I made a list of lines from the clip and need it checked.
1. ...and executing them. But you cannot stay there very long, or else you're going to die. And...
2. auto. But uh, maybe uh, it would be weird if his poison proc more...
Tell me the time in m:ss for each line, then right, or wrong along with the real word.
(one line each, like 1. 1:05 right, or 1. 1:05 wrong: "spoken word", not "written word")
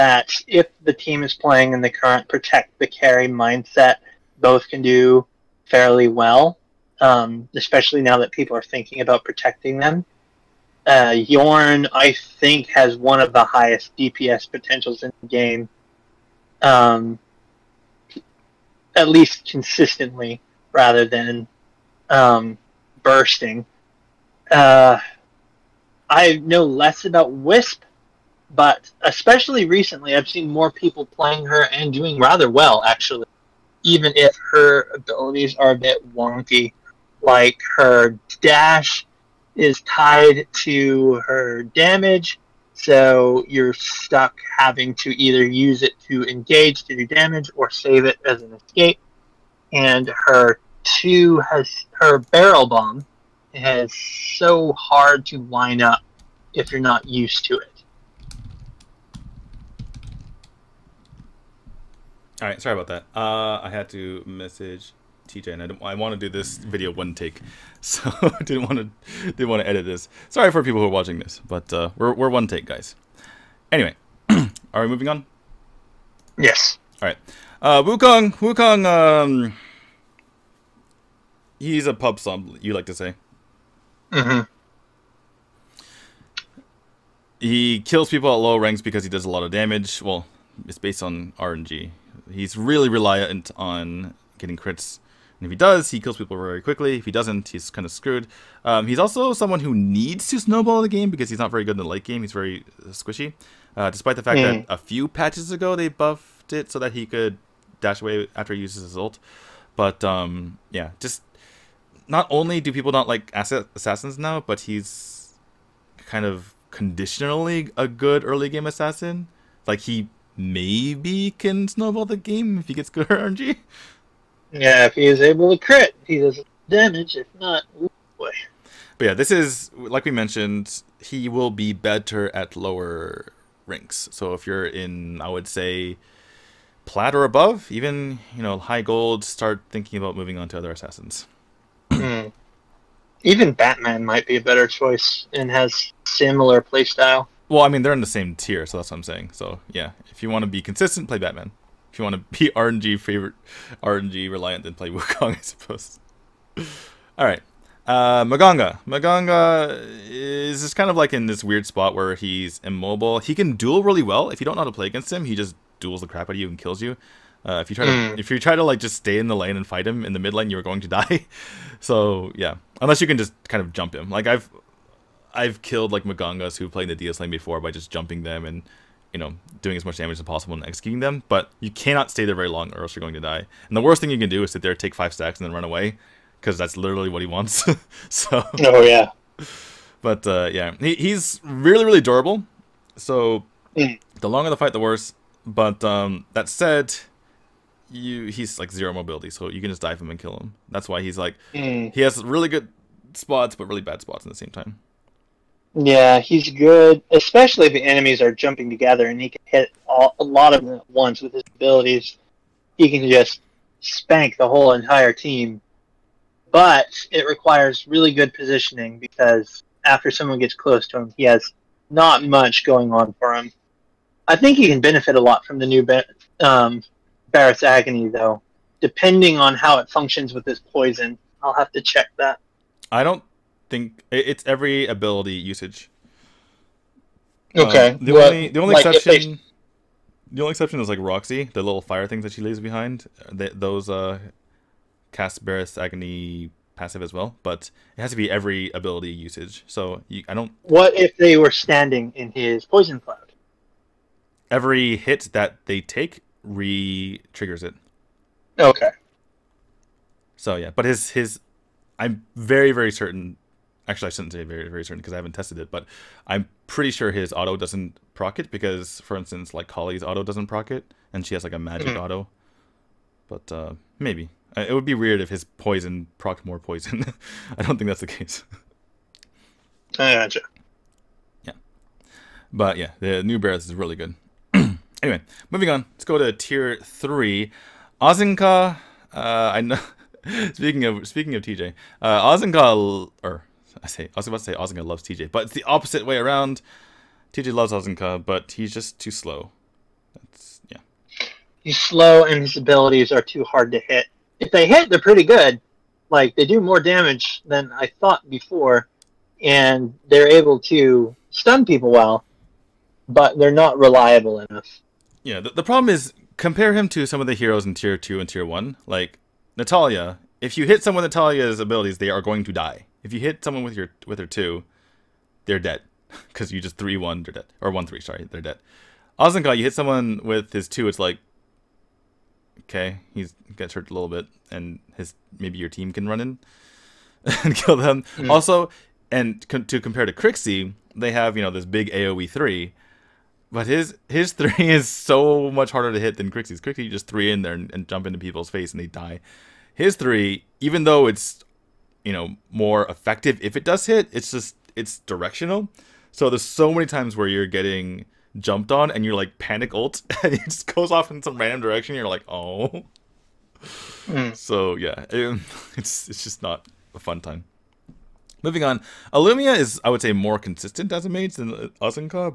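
1. 3:00 right
2. 4:31 right.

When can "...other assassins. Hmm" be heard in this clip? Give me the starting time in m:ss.
2:20.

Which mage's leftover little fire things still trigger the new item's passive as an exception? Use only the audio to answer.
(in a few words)
Roxie.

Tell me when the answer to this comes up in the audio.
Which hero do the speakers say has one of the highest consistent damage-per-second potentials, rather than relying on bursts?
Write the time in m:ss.
0:11.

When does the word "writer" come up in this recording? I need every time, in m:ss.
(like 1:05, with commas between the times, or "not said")
not said.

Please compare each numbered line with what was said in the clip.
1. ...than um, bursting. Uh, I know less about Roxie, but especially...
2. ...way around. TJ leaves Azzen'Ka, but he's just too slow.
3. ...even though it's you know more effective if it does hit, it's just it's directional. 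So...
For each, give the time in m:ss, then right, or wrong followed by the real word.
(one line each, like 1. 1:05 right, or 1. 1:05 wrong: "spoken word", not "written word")
1. 0:21 wrong: "Wisp", not "Roxie"
2. 4:56 wrong: "loves", not "leaves"
3. 5:50 right.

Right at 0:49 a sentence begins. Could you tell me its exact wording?
And her two has her barrel bomb, is so hard to line up if you're not used to it.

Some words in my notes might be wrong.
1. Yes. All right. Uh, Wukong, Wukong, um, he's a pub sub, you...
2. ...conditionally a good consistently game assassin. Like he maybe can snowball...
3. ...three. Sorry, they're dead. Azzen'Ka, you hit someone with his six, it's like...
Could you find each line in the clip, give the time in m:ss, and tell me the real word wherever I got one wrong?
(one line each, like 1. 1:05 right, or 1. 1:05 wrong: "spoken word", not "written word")
1. 1:16 right
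2. 1:56 wrong: "early", not "consistently"
3. 5:27 wrong: "two", not "six".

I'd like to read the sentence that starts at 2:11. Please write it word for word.
He will be better at lower ranks.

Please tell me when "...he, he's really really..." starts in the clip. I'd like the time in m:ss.
3:10.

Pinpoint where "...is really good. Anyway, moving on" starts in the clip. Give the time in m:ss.
4:43.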